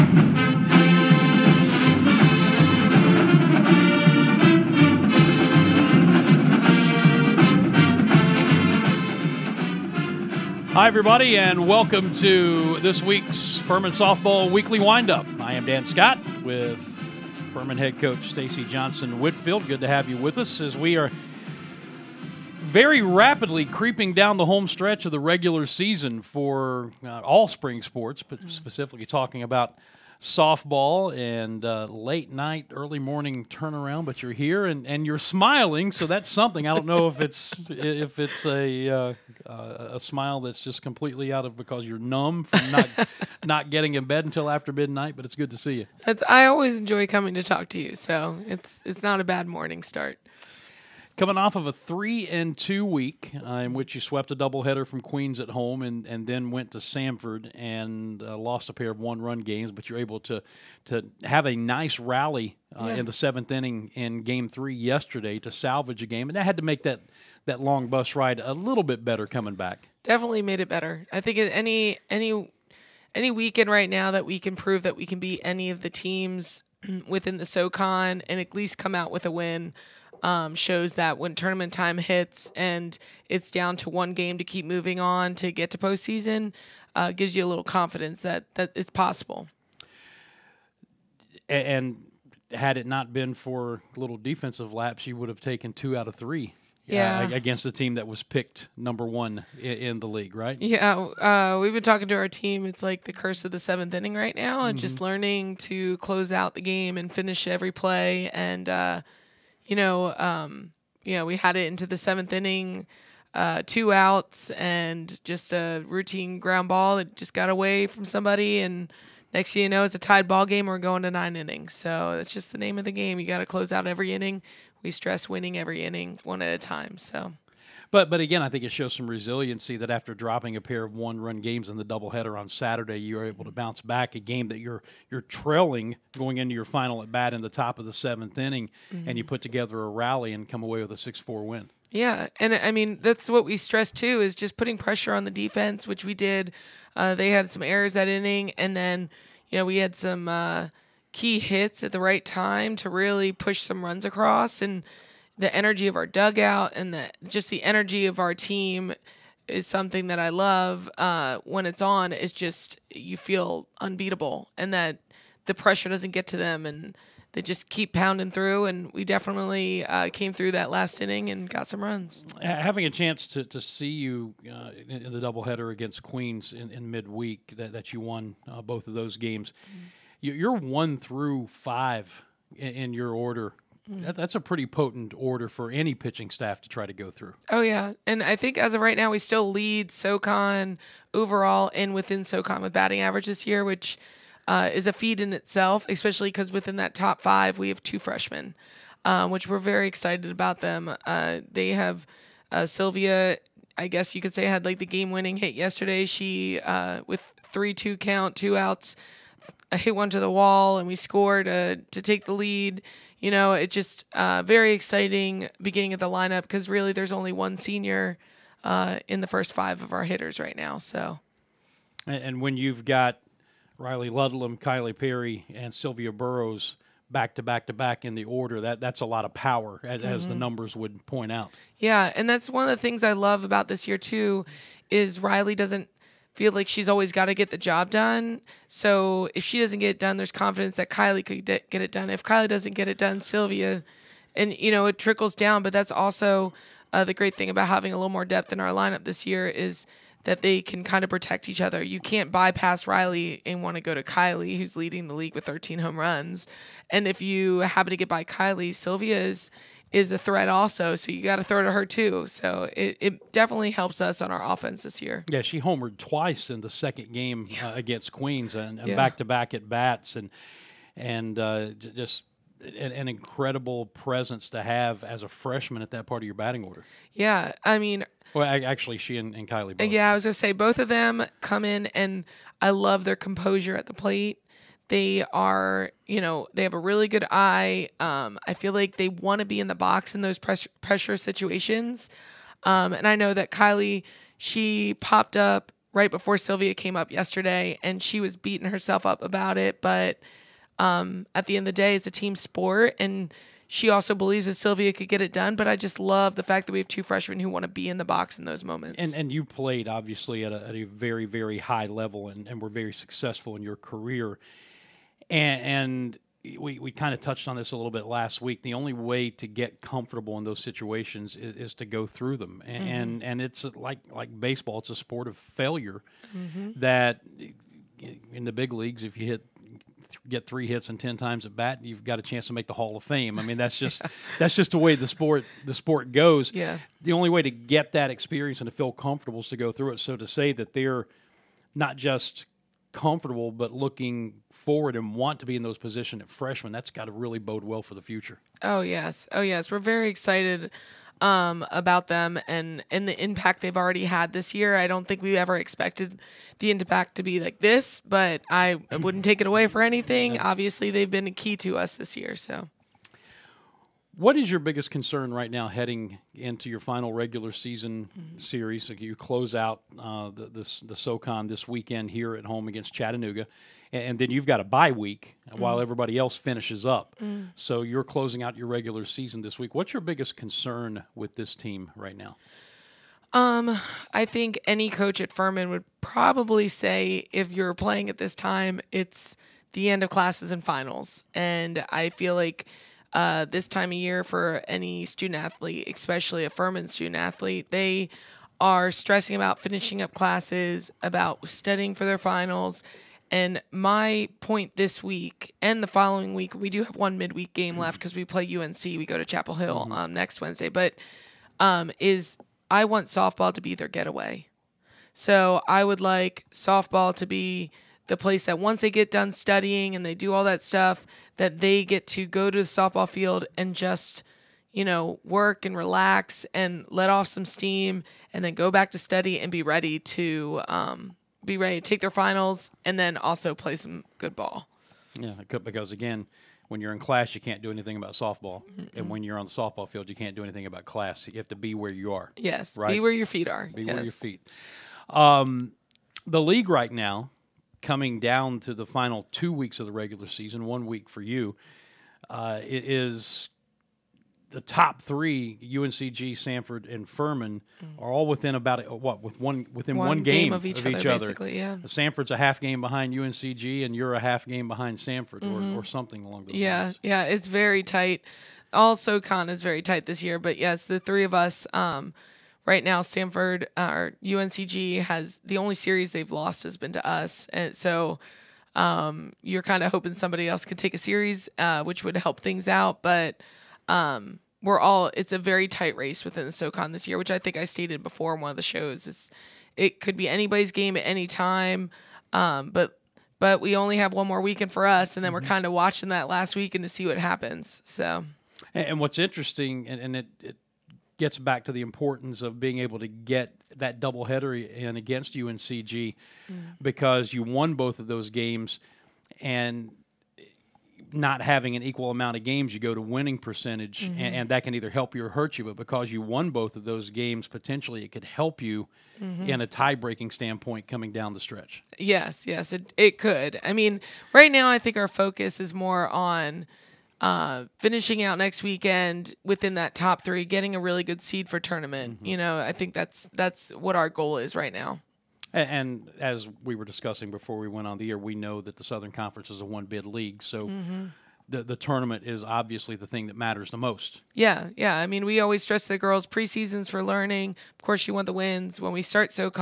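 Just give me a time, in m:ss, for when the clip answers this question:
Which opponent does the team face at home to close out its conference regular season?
6:12.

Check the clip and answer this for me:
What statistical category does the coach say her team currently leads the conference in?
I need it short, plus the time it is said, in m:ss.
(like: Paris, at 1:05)
Batting average, at 3:12.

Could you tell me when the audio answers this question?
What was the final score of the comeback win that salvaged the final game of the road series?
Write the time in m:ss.
2:20.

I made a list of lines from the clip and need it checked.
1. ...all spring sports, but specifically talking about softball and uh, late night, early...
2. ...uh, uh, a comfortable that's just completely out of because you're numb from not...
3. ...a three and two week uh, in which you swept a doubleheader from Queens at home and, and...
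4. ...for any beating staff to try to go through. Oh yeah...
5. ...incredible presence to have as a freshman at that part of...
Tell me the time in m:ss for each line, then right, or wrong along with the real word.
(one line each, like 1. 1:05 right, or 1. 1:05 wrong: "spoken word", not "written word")
1. 0:27 right
2. 0:38 wrong: "smile", not "comfortable"
3. 0:51 right
4. 3:05 wrong: "pitching", not "beating"
5. 4:33 right.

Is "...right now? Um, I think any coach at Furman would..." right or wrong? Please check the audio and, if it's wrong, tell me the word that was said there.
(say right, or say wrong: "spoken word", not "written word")
right.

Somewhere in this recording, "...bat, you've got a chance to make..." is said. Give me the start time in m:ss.
5:31.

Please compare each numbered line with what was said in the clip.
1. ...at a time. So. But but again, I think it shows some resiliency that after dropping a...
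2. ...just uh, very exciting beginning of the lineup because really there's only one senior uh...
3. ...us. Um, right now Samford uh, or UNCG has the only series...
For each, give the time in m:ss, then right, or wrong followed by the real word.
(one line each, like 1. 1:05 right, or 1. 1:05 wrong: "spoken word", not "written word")
1. 2:06 right
2. 3:33 right
3. 7:51 right.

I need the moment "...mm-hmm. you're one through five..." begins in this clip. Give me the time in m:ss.
2:59.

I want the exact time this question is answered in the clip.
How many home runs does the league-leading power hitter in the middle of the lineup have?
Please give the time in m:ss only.
4:15.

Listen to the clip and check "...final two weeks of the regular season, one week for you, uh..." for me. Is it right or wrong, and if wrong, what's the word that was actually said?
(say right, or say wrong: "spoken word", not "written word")
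right.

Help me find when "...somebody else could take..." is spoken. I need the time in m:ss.
8:00.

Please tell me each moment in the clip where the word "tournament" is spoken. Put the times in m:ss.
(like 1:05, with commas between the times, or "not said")
1:21, 8:51, 9:01.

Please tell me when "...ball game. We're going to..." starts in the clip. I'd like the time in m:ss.
2:00.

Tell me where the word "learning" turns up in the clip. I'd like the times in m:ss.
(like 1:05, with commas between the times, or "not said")
1:44, 9:07.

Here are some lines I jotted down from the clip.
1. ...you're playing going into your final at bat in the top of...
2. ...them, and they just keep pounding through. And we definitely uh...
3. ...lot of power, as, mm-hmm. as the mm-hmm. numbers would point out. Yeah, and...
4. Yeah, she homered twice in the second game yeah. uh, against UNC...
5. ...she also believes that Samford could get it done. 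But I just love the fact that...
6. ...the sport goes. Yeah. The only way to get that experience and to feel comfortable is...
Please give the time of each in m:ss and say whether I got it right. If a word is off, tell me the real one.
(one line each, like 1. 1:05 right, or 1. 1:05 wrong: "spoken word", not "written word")
1. 2:15 wrong: "trailing", not "playing"
2. 2:46 right
3. 3:49 right
4. 4:25 wrong: "Queens", not "UNC"
5. 5:03 wrong: "Sylvia", not "Samford"
6. 5:35 right.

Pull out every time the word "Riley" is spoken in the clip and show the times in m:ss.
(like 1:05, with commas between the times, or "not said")
3:43, 3:55, 4:12.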